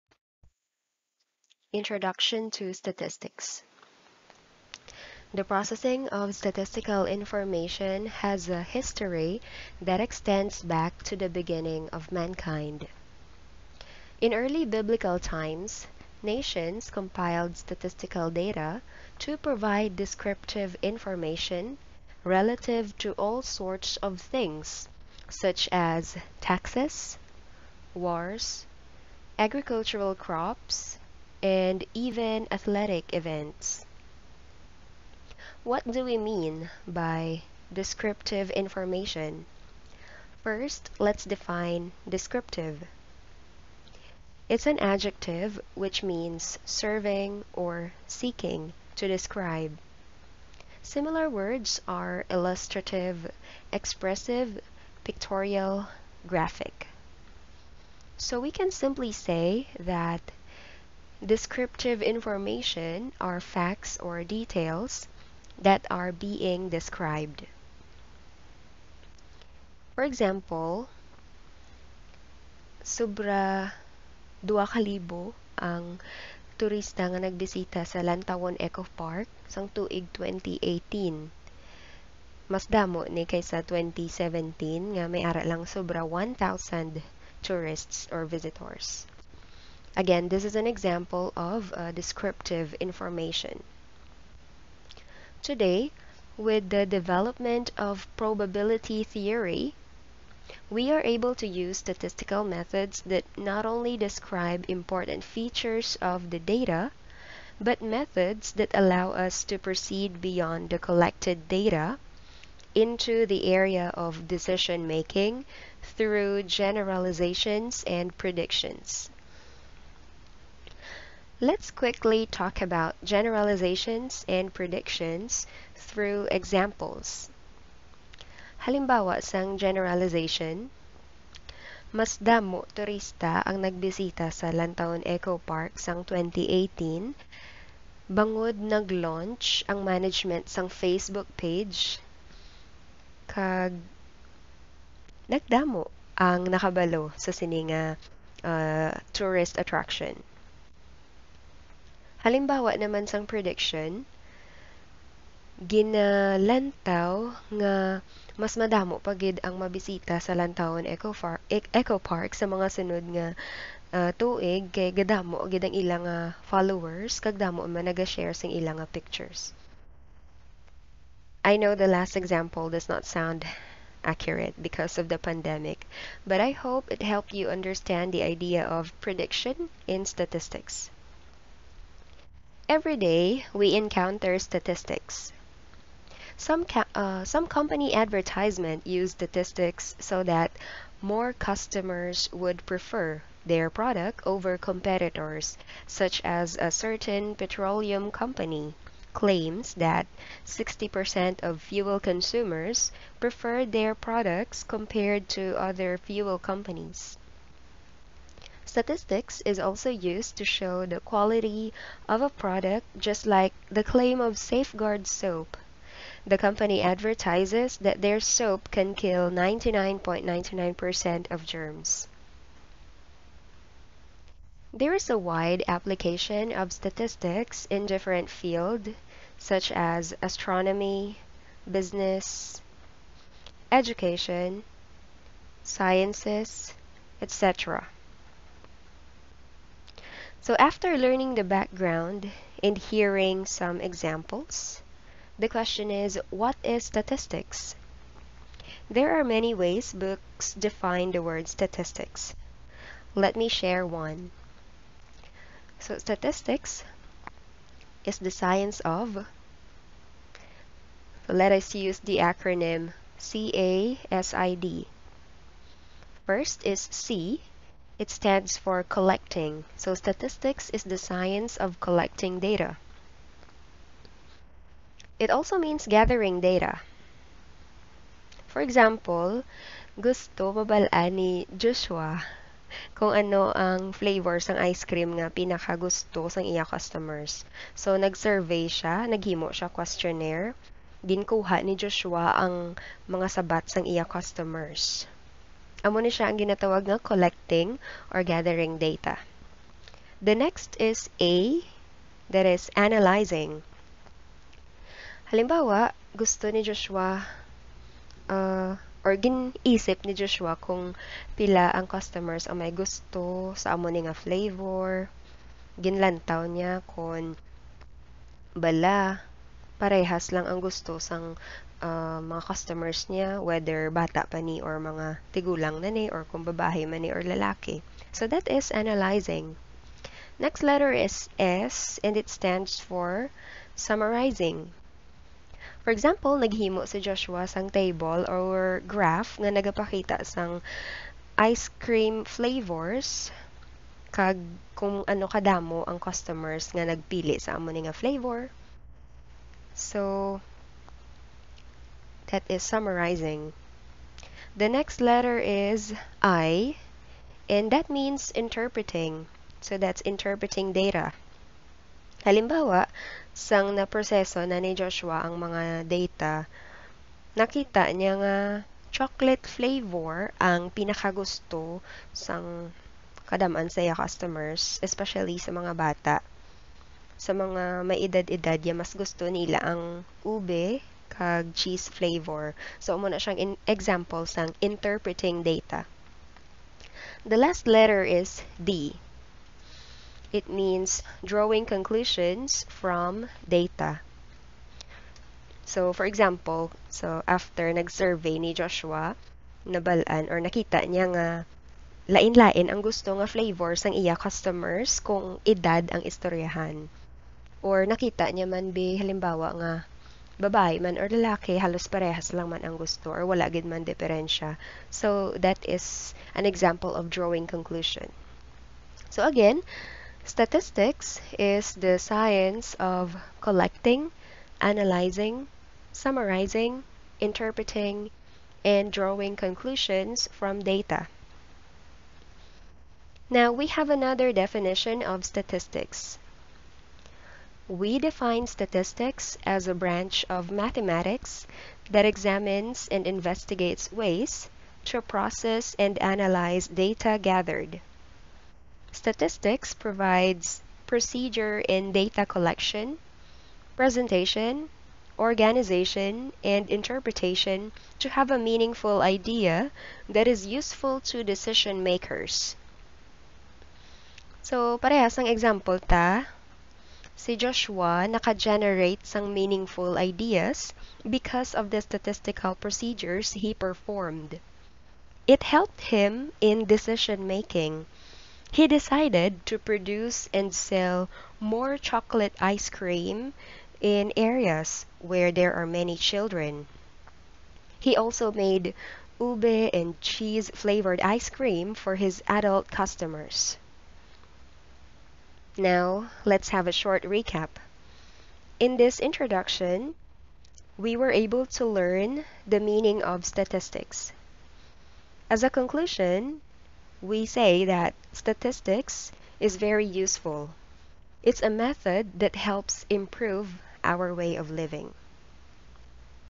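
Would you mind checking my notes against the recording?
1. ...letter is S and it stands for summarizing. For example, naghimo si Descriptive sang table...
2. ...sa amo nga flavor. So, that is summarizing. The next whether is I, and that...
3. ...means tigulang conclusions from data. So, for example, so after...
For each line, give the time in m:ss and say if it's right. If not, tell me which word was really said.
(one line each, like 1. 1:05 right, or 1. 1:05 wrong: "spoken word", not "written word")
1. 5:30 wrong: "Joshua", not "Descriptive"
2. 5:47 wrong: "letter", not "whether"
3. 6:30 wrong: "drawing", not "tigulang".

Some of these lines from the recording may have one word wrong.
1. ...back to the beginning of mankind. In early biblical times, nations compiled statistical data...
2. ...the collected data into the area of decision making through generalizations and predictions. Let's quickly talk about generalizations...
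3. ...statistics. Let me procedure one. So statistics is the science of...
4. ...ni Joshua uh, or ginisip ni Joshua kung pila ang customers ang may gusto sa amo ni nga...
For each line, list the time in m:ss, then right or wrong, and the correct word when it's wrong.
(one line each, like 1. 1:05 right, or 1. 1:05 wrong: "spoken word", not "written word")
1. 0:10 right
2. 1:50 right
3. 4:11 wrong: "share", not "procedure"
4. 5:06 right.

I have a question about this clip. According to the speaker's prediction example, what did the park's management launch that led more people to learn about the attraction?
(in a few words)
Facebook page.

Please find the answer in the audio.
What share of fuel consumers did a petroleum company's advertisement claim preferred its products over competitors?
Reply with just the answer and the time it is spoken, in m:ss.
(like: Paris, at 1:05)
60%, at 3:20.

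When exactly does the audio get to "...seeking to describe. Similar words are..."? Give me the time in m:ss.
0:48.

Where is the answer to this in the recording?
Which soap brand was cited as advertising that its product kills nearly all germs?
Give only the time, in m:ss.
3:34.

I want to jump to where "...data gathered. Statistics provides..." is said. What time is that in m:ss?
7:26.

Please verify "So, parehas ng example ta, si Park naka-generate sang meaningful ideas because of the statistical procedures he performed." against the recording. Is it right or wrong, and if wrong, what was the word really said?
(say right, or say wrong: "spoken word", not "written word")
wrong: "Joshua", not "Park".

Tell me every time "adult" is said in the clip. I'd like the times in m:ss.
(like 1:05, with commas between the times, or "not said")
8:12.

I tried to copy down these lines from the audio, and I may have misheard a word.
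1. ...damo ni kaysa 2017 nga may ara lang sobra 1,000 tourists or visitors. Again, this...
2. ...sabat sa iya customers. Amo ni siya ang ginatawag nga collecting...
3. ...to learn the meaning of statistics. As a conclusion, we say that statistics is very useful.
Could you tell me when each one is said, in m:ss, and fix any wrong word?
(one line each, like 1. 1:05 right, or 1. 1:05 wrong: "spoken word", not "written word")
1. 1:22 right
2. 4:53 right
3. 8:21 right.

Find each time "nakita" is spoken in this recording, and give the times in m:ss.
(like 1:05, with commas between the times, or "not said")
6:07, 6:40, 6:47.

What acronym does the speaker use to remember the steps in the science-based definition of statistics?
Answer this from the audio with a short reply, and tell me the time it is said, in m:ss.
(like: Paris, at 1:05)
CASID, at 4:23.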